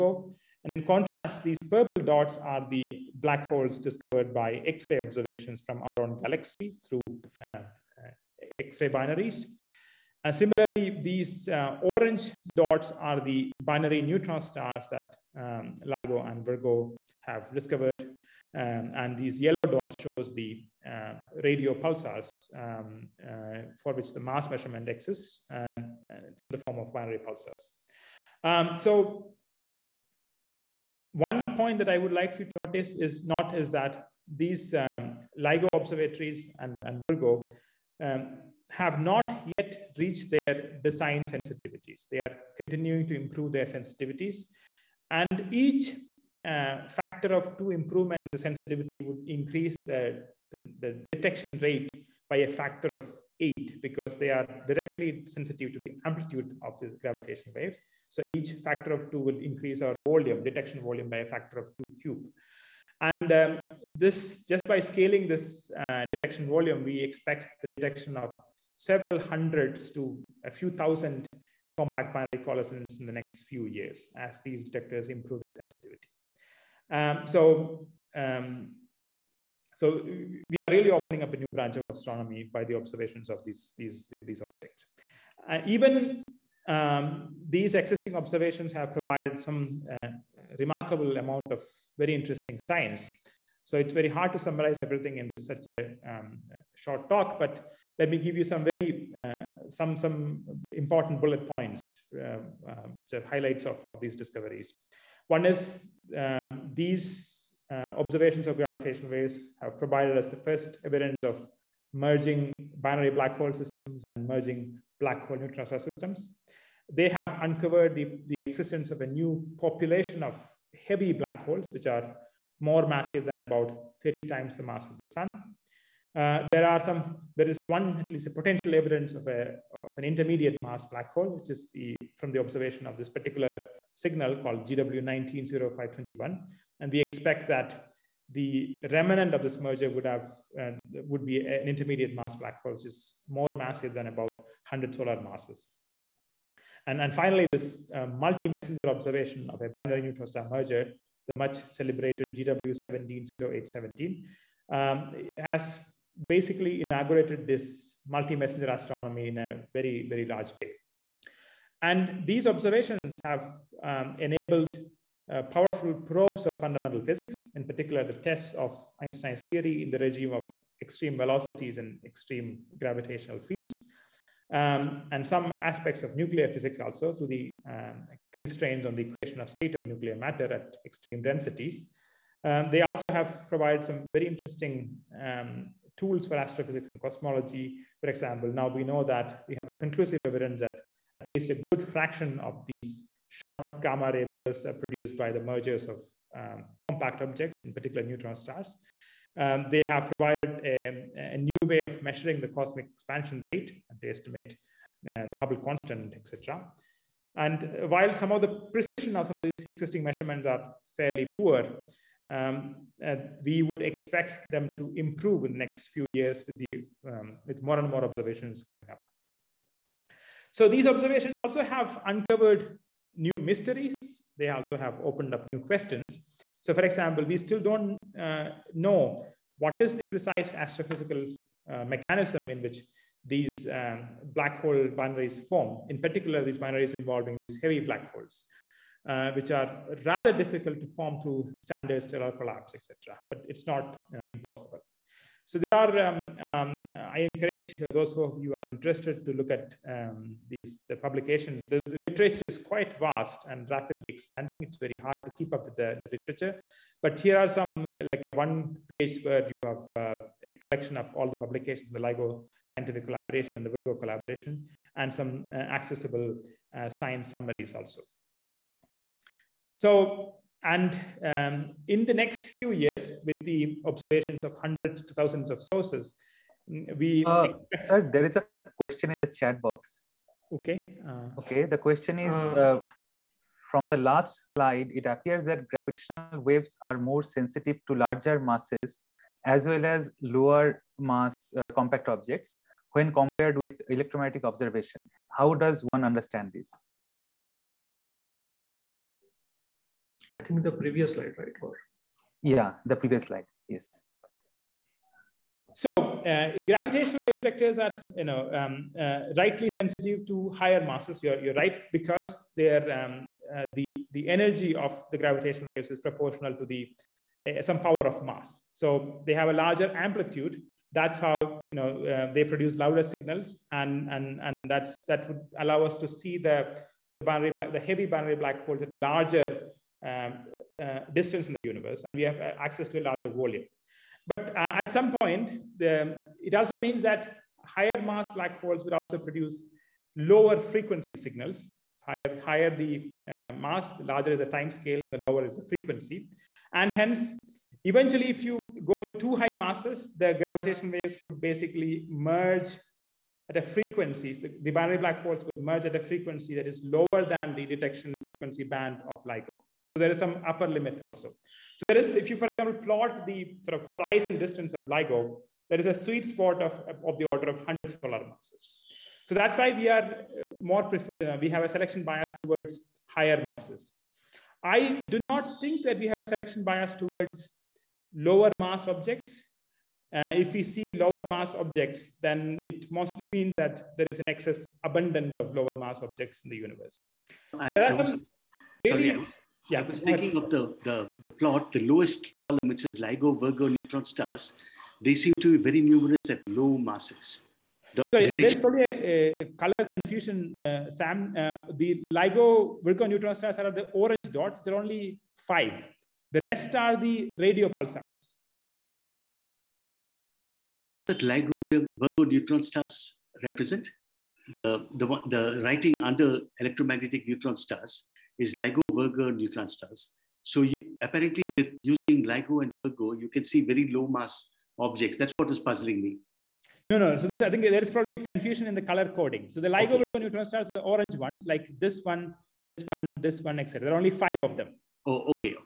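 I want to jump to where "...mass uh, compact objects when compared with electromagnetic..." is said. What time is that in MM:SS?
04:50.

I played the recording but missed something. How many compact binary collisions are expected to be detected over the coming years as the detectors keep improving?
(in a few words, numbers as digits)
several hundreds to a few thousand.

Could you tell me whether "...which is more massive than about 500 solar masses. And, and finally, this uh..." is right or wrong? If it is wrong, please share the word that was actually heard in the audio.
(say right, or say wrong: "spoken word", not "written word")
wrong: "100", not "500".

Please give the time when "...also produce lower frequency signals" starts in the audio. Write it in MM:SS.
05:38.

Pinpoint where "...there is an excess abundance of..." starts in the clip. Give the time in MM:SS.
06:23.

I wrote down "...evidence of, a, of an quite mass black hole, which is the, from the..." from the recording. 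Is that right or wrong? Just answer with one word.
wrong.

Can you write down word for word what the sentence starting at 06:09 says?
So that's why we are uh, more, uh, we have a selection bias towards higher masses.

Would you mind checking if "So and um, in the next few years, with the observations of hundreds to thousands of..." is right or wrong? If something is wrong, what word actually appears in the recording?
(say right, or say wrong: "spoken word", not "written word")
right.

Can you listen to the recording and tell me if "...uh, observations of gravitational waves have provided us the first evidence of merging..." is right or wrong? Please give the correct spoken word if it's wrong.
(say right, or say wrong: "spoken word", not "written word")
right.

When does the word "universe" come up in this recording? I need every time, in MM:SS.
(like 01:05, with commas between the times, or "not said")
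05:31, 06:26.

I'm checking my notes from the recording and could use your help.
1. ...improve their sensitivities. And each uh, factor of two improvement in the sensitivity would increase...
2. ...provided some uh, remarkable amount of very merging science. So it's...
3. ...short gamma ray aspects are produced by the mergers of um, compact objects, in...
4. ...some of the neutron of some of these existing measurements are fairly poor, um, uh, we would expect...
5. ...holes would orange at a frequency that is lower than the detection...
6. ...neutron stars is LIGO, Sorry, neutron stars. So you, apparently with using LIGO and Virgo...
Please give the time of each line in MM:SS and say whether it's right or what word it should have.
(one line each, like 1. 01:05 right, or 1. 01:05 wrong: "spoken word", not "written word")
1. 00:43 right
2. 01:28 wrong: "interesting", not "merging"
3. 03:13 wrong: "bursts", not "aspects"
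4. 03:28 wrong: "precision", not "neutron"
5. 05:55 wrong: "merge", not "orange"
6. 06:57 wrong: "Virgo", not "Sorry".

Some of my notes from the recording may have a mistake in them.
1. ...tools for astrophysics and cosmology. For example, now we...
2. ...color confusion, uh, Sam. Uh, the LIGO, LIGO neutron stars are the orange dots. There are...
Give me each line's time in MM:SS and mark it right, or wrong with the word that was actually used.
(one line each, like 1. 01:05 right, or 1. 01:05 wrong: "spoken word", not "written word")
1. 03:05 right
2. 06:39 wrong: "Virgo", not "LIGO".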